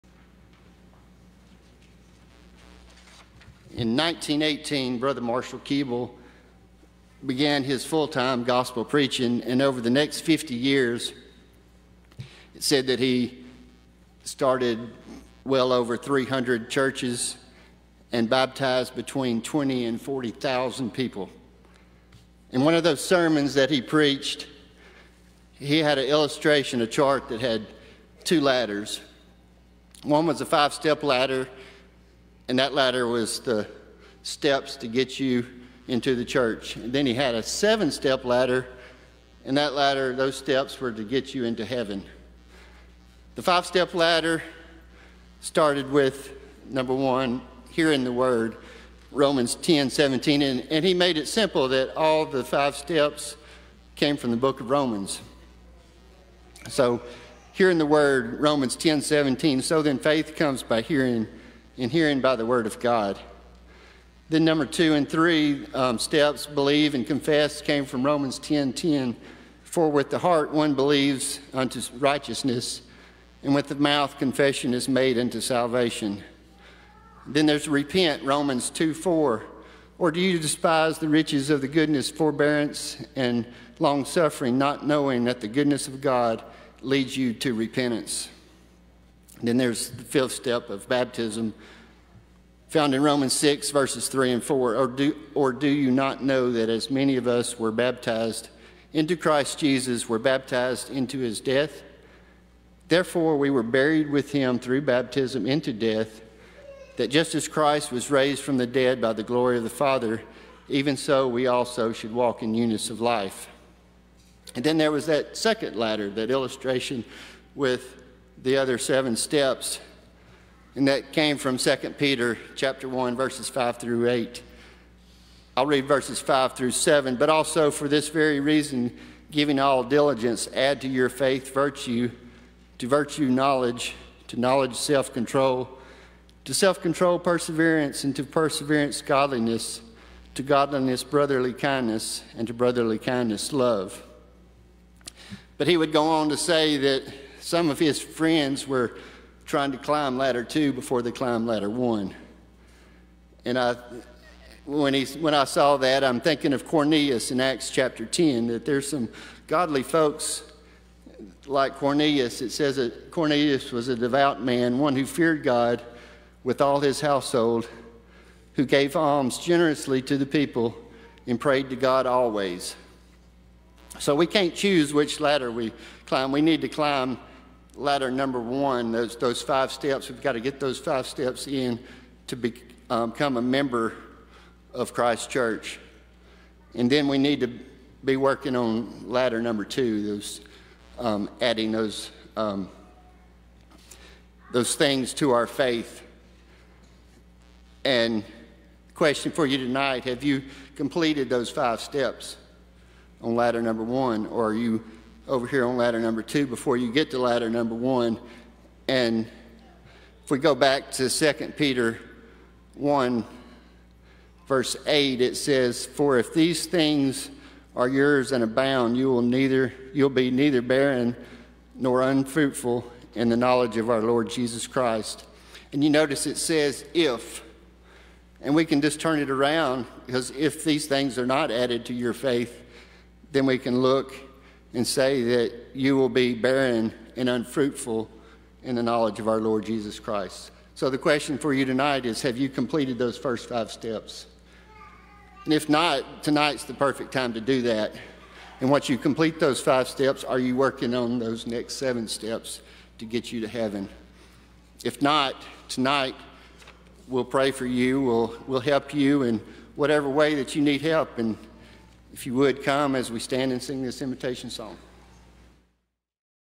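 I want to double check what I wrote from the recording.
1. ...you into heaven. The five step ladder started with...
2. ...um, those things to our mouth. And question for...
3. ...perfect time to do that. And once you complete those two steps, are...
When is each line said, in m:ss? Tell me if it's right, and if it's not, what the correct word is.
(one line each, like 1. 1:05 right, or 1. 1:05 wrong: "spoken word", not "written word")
1. 0:41 right
2. 3:12 wrong: "faith", not "mouth"
3. 4:06 wrong: "five", not "two".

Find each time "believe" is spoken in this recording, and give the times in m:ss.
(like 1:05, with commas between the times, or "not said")
1:06, 1:10.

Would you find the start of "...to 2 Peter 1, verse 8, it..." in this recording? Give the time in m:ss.
3:30.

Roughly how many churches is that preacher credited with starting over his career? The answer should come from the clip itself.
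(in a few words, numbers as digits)
over 300.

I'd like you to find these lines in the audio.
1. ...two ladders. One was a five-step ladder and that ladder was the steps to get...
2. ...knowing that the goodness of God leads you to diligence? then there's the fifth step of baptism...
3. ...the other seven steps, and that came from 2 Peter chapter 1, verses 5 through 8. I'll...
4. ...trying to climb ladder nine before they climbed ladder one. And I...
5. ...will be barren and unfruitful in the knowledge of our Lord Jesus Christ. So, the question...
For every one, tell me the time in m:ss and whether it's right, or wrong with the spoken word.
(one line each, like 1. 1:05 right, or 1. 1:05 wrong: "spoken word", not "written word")
1. 0:28 right
2. 1:24 wrong: "repentance", not "diligence"
3. 1:58 right
4. 2:29 wrong: "two", not "nine"
5. 3:55 right.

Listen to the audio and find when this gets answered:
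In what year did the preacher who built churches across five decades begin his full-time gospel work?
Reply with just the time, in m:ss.
0:03.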